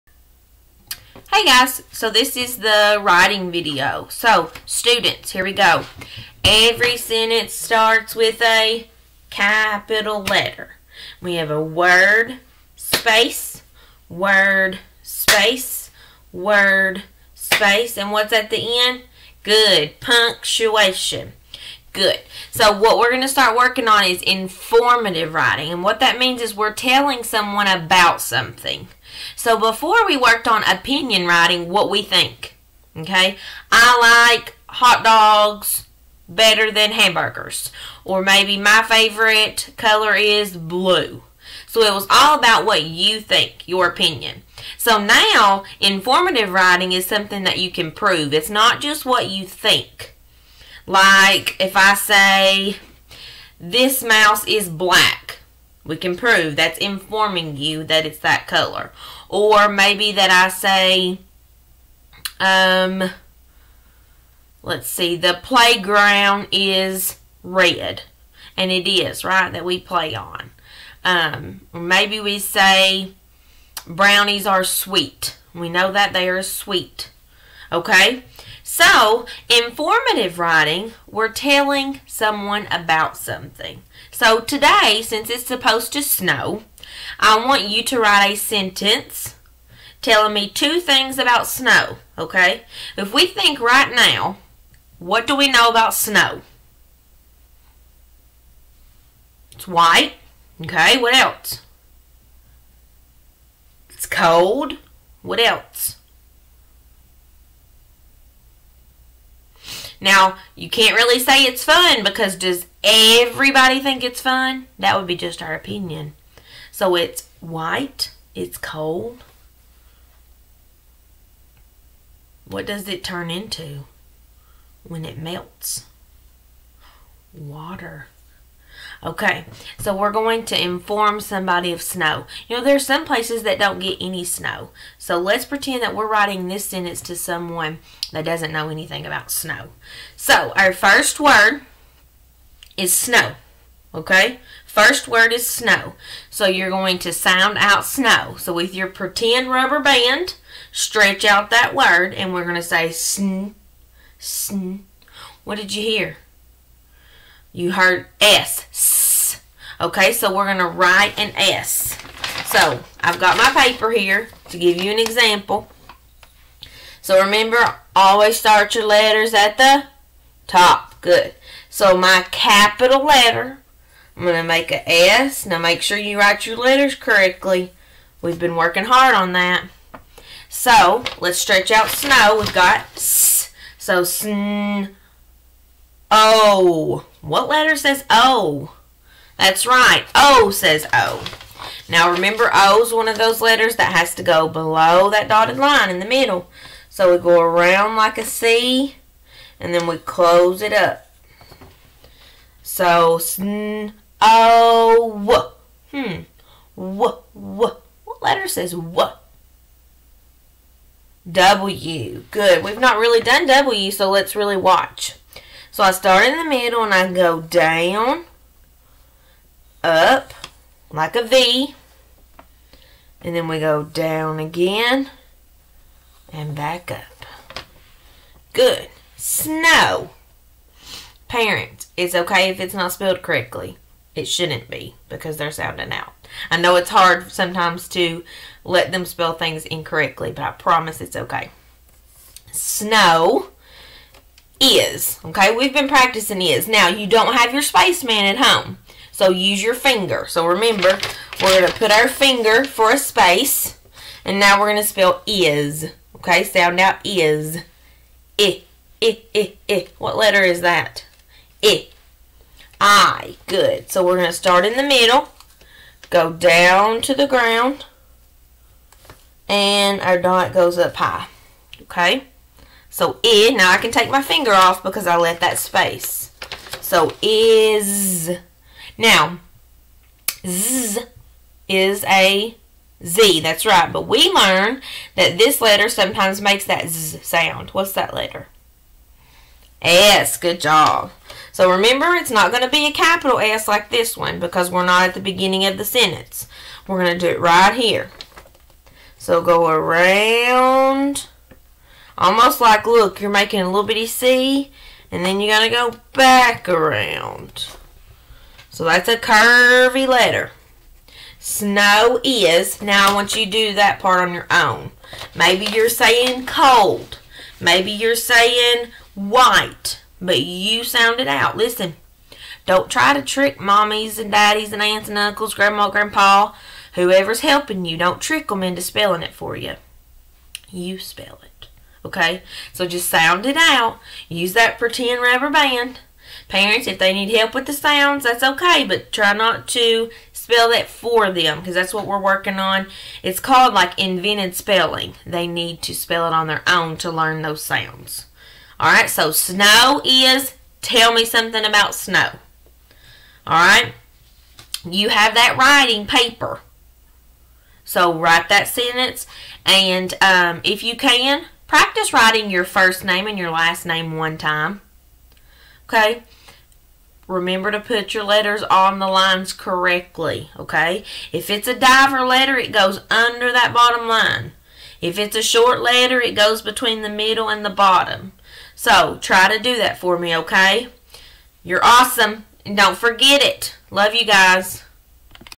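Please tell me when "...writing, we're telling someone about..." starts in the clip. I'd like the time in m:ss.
1:20.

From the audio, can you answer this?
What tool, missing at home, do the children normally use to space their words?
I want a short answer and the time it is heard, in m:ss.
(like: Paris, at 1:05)
Spaceman, at 4:07.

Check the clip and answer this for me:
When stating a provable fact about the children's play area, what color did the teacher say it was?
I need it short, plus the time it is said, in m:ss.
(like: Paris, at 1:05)
Red, at 1:07.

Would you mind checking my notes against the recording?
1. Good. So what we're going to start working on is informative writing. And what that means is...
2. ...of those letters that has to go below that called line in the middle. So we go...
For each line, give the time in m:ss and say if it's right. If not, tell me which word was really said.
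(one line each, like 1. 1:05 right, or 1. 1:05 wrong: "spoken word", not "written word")
1. 0:21 right
2. 3:13 wrong: "dotted", not "called".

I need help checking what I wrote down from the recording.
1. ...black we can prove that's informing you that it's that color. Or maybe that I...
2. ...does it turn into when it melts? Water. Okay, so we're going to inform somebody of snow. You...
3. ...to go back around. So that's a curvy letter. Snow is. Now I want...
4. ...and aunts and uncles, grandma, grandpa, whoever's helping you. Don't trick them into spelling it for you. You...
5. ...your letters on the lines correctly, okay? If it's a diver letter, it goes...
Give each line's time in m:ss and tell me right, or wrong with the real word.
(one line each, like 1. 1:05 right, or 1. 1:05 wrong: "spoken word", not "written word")
1. 0:54 right
2. 2:02 right
3. 5:05 right
4. 5:24 right
5. 6:08 right.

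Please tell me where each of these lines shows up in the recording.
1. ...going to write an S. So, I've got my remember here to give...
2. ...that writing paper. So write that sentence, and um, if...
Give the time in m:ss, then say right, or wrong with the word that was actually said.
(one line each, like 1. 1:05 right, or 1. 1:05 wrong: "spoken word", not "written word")
1. 2:40 wrong: "paper", not "remember"
2. 5:55 right.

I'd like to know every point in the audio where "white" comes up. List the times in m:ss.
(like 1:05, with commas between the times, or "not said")
1:39, 1:57, 5:19.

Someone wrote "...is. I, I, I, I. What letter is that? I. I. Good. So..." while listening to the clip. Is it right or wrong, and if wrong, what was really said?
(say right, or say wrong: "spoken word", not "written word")
right.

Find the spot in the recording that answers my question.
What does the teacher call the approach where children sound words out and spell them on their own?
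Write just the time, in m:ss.
5:43.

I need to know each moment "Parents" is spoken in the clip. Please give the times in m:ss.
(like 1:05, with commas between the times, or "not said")
3:51, 5:36.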